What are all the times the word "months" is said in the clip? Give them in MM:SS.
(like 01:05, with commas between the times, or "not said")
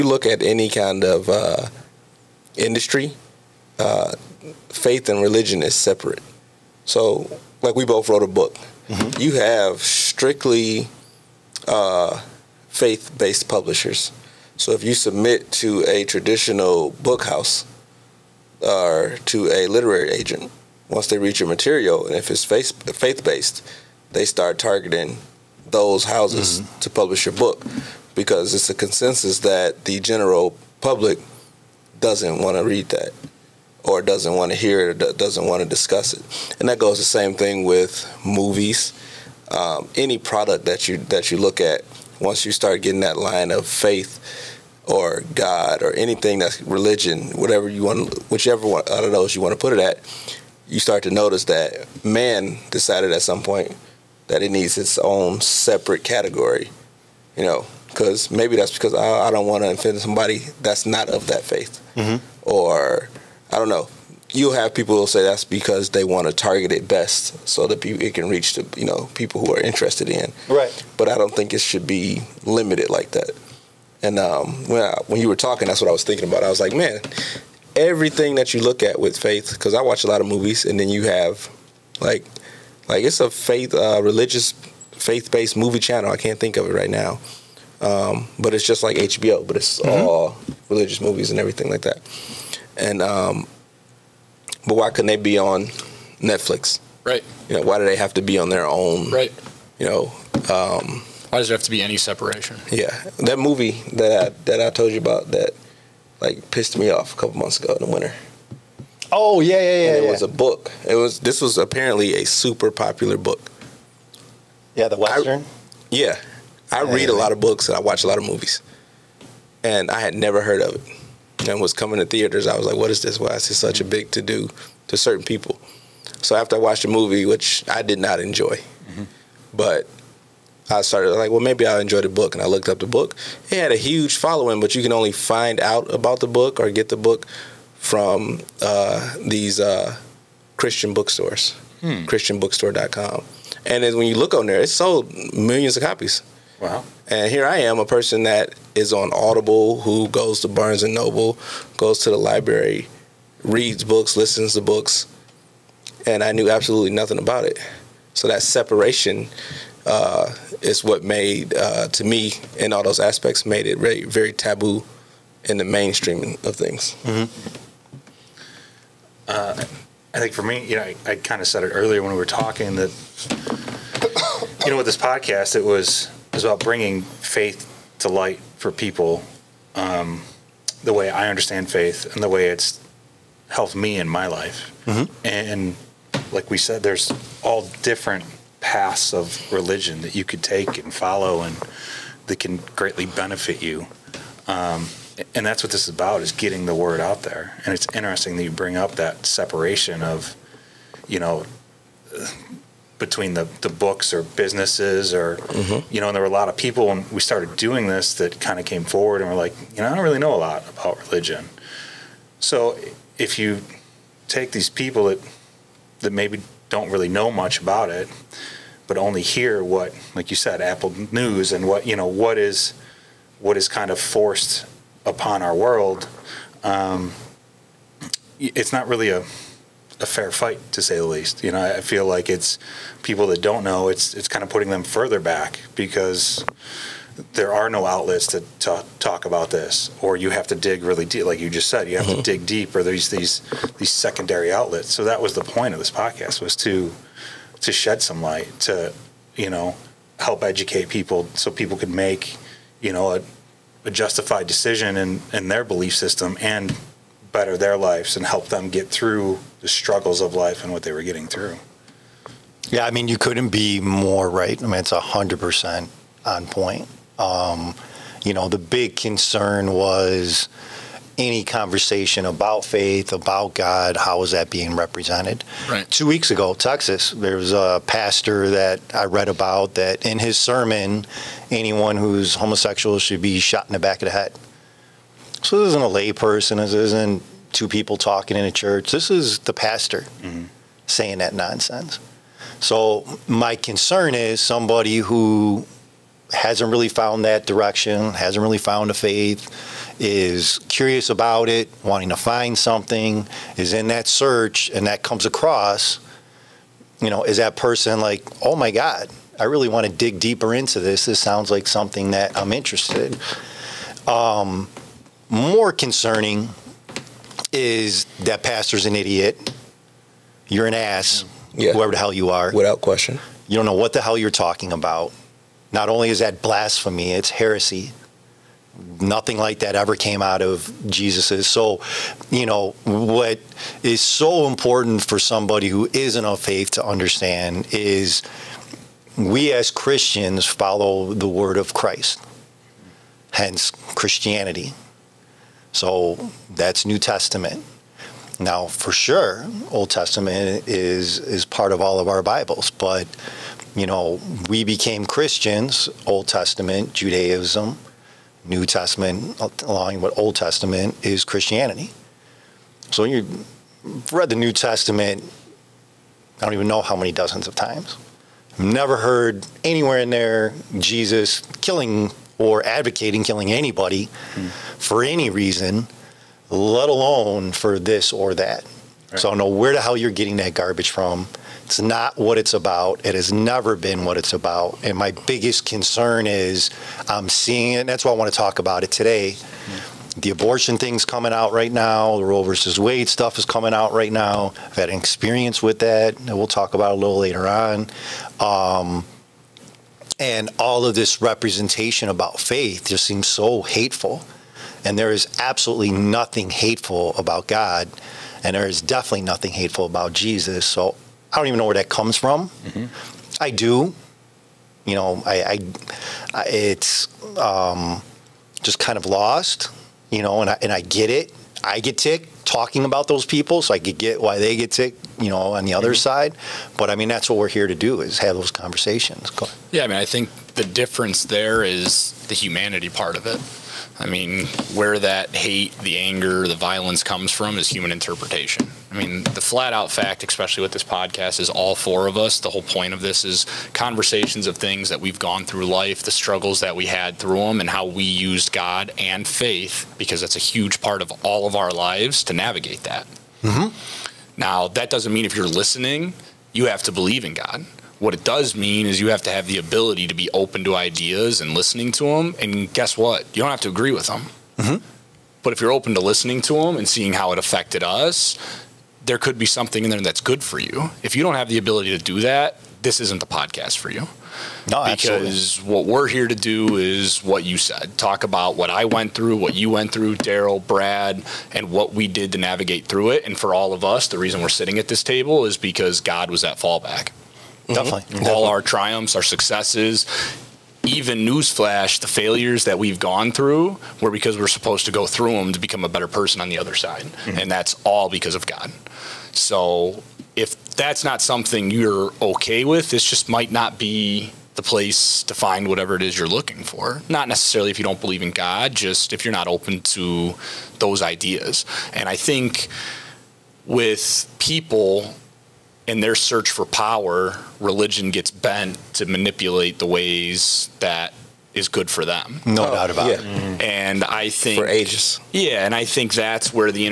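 01:47.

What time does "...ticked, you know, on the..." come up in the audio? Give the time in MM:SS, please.
07:04.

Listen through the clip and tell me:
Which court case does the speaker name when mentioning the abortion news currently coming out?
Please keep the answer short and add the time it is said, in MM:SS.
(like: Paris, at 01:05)
Roe versus Wade, at 06:32.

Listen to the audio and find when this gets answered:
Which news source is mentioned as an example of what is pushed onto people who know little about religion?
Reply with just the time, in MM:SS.
03:40.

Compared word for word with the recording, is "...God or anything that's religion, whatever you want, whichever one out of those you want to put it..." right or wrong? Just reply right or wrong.
right.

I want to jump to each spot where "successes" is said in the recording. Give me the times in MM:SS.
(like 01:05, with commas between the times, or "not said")
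08:09.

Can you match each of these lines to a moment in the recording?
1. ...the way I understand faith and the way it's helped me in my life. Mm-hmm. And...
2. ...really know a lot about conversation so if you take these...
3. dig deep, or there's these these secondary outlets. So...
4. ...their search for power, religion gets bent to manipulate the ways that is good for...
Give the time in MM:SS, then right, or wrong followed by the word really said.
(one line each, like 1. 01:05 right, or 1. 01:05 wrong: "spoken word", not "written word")
1. 03:00 right
2. 03:30 wrong: "religion", not "conversation"
3. 04:02 right
4. 08:36 right.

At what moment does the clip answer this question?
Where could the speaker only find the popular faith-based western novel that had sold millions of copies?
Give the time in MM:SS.
02:20.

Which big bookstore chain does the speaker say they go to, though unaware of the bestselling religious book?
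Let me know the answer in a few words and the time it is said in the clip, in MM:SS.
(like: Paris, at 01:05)
Barnes and Noble, at 02:30.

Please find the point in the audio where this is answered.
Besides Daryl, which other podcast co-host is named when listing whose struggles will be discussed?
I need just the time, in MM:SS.
08:00.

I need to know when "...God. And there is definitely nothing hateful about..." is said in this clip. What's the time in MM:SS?
06:47.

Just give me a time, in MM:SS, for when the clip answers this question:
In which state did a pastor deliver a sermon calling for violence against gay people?
04:36.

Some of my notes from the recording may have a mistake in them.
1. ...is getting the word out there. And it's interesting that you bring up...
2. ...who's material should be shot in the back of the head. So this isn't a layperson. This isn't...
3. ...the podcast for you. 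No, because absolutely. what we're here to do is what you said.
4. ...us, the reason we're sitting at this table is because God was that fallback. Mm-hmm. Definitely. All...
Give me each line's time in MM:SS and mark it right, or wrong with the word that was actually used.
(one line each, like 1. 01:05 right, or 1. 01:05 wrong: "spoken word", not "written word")
1. 03:16 right
2. 04:41 wrong: "homosexual", not "material"
3. 07:53 right
4. 08:03 right.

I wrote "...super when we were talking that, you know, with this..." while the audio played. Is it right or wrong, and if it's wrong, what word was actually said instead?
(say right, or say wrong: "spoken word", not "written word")
wrong: "earlier", not "super".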